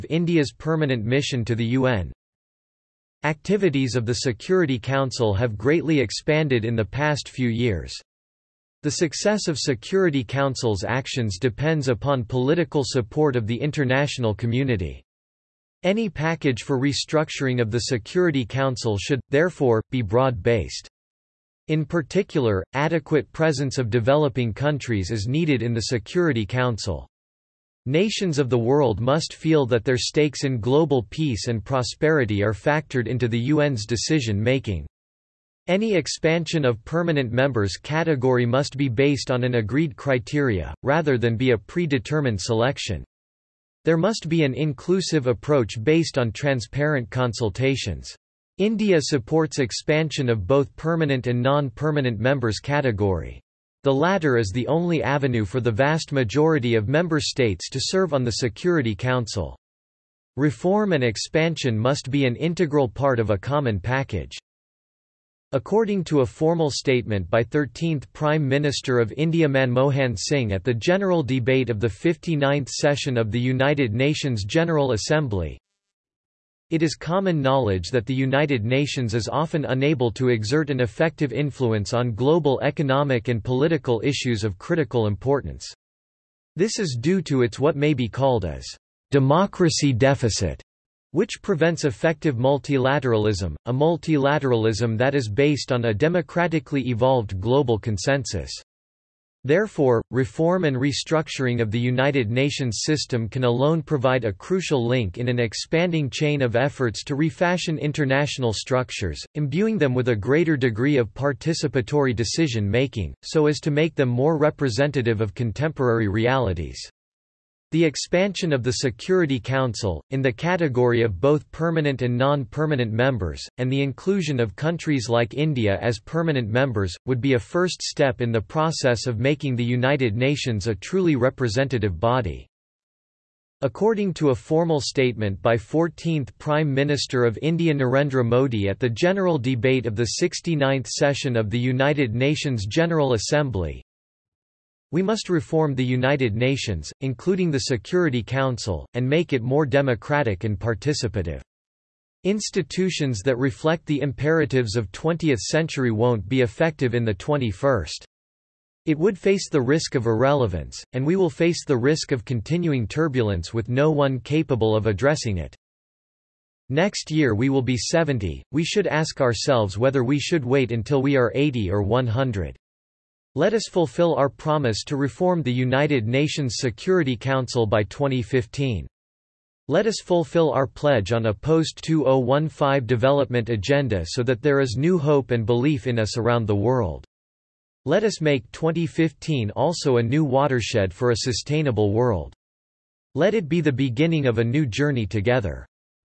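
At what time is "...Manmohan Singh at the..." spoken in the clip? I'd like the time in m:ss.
1:09.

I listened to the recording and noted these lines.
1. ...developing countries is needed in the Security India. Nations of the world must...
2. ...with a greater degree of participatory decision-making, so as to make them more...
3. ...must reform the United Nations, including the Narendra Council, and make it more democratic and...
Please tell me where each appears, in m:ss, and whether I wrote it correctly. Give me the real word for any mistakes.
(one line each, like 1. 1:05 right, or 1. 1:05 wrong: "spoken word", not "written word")
1. 0:23 wrong: "Council", not "India"
2. 1:49 right
3. 2:25 wrong: "Security", not "Narendra".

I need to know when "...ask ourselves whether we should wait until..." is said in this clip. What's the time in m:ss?
2:48.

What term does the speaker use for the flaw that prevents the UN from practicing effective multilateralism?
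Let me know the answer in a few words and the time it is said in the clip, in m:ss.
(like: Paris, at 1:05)
democracy deficit, at 1:29.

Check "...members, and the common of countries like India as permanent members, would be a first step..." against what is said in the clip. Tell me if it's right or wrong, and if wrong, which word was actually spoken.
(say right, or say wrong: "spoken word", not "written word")
wrong: "inclusion", not "common".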